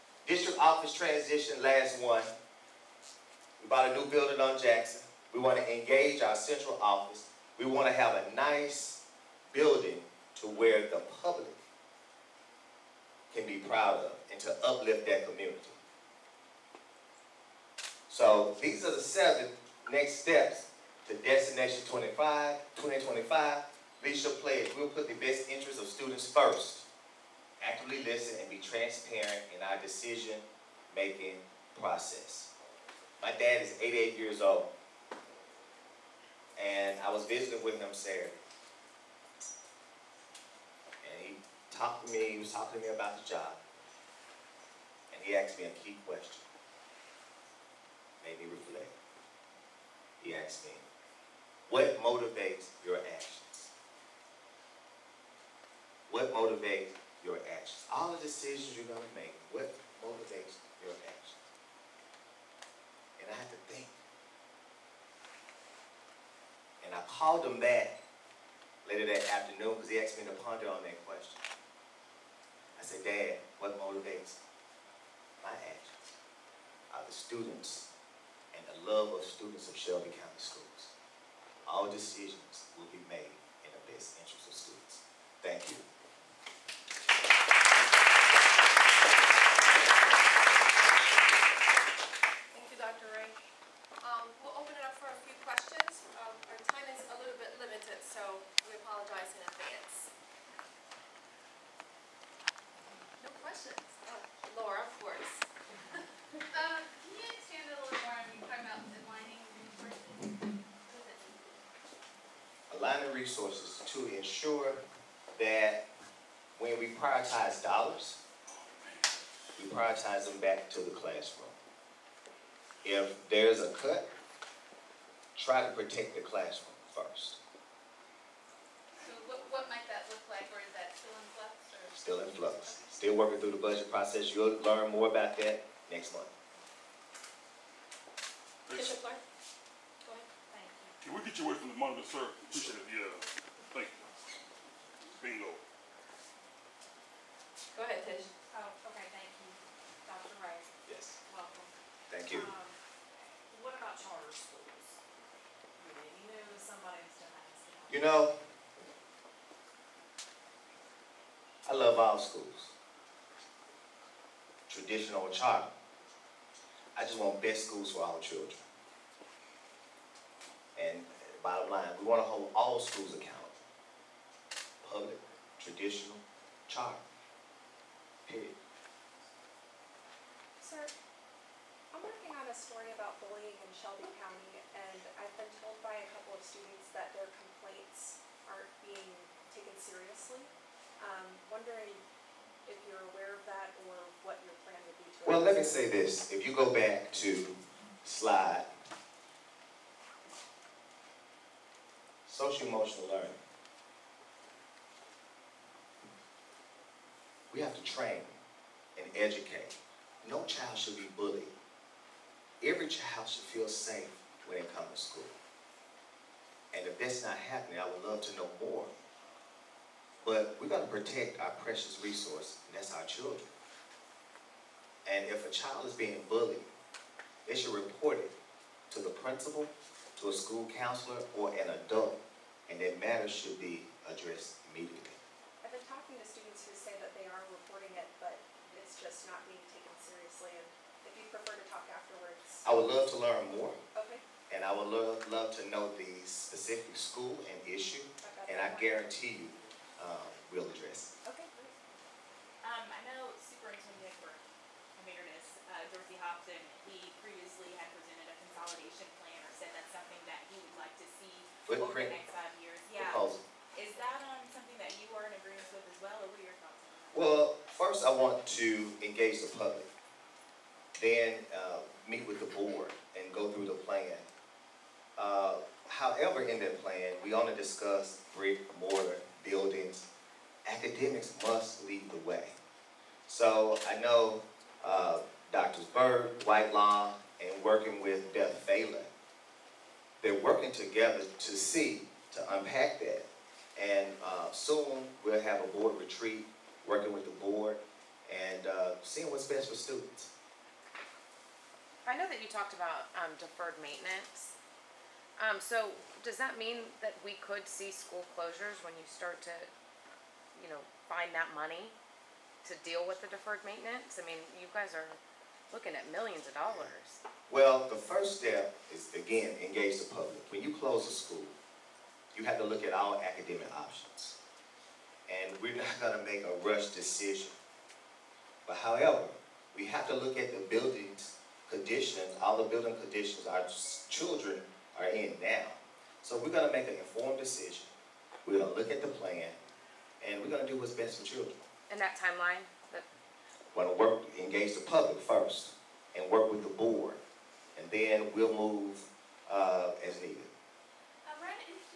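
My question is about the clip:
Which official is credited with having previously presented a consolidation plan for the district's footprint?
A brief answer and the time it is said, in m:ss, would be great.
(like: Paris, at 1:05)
Dorsey Hopson, at 4:15.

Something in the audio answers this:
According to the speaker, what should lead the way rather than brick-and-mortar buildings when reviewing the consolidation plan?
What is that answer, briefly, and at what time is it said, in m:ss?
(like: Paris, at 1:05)
Academics, at 4:40.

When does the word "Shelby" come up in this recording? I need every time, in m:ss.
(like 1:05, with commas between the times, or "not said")
1:19, 3:03.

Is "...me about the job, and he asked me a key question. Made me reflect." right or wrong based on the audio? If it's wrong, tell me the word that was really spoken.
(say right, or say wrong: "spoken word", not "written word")
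right.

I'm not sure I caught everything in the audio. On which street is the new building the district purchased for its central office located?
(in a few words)
Jackson.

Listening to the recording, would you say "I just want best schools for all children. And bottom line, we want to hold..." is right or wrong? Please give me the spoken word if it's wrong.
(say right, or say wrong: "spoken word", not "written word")
right.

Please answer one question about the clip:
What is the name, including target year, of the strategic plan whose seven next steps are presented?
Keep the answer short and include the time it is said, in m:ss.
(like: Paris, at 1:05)
Destination 2025, at 0:21.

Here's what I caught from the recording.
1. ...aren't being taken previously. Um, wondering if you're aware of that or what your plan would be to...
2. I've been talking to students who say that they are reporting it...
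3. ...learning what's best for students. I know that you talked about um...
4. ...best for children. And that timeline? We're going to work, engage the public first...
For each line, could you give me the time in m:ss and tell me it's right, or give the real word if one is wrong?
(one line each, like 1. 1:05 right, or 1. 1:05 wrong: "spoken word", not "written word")
1. 3:08 wrong: "seriously", not "previously"
2. 3:55 right
3. 4:59 wrong: "seeing", not "learning"
4. 5:40 right.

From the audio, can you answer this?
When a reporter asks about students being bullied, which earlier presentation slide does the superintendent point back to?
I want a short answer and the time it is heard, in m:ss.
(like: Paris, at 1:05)
Social-emotional learning, at 3:22.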